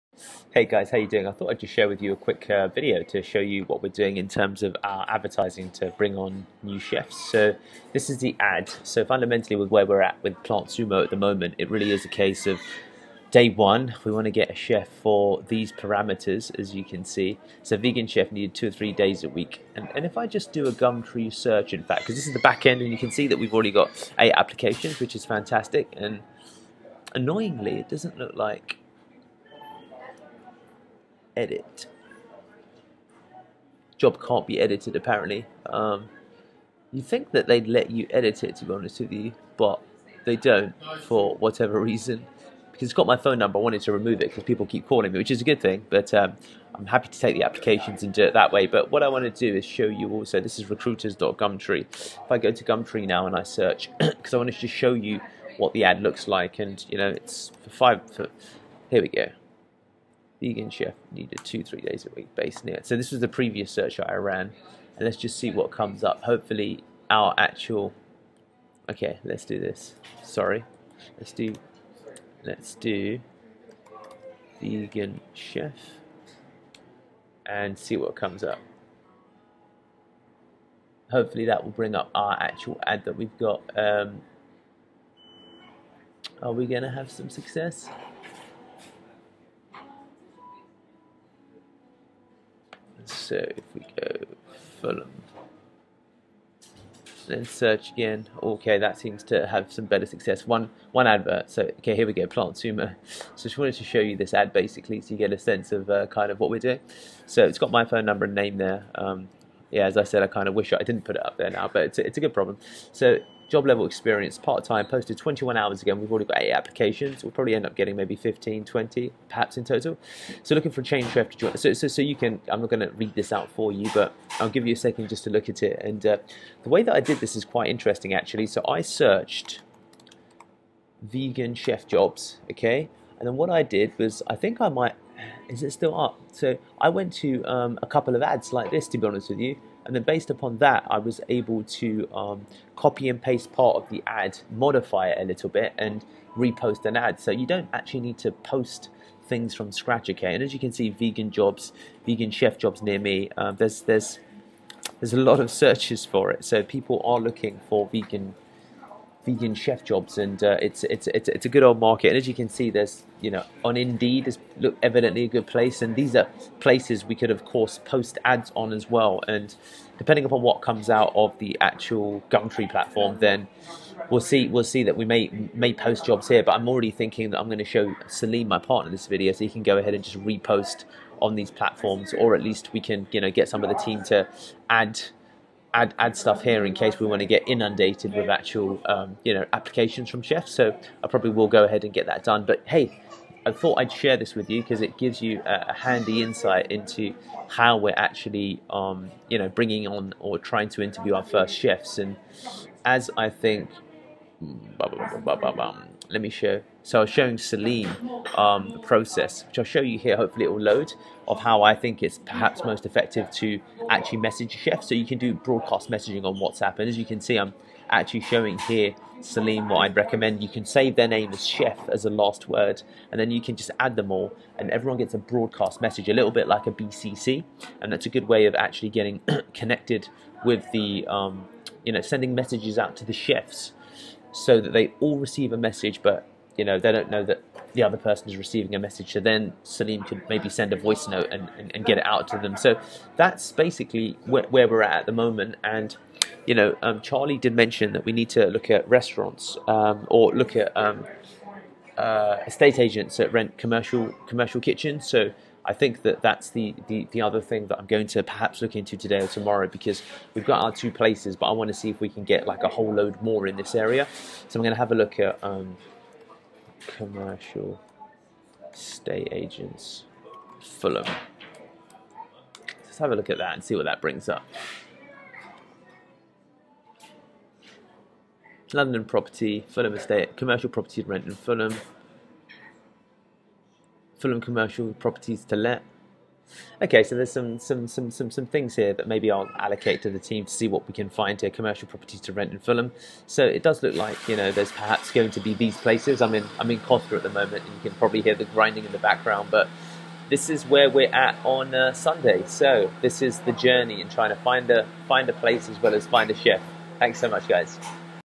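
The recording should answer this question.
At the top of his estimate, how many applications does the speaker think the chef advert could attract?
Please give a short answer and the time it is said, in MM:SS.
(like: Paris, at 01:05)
20, at 01:58.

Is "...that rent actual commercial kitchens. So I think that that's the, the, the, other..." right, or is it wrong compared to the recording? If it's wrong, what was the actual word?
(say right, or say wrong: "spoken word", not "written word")
wrong: "commercial", not "actual".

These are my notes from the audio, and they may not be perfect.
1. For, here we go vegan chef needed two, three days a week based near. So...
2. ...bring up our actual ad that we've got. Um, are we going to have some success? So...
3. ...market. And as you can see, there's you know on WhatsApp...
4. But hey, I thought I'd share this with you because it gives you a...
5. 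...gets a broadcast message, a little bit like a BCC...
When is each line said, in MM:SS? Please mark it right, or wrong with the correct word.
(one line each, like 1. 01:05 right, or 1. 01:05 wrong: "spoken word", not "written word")
1. 00:58 right
2. 01:21 right
3. 02:41 wrong: "Indeed", not "WhatsApp"
4. 03:12 right
5. 03:44 right.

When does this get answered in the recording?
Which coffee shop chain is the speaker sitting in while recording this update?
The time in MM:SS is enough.
04:56.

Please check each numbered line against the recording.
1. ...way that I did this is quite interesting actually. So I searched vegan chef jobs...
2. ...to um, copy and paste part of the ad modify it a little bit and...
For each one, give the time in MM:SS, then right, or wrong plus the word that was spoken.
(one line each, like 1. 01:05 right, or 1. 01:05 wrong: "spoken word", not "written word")
1. 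02:06 right
2. 02:21 right.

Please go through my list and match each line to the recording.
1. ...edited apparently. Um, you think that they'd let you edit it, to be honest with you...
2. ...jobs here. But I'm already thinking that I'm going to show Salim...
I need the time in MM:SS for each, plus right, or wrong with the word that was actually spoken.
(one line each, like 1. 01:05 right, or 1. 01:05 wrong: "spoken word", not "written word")
1. 00:34 right
2. 02:56 right.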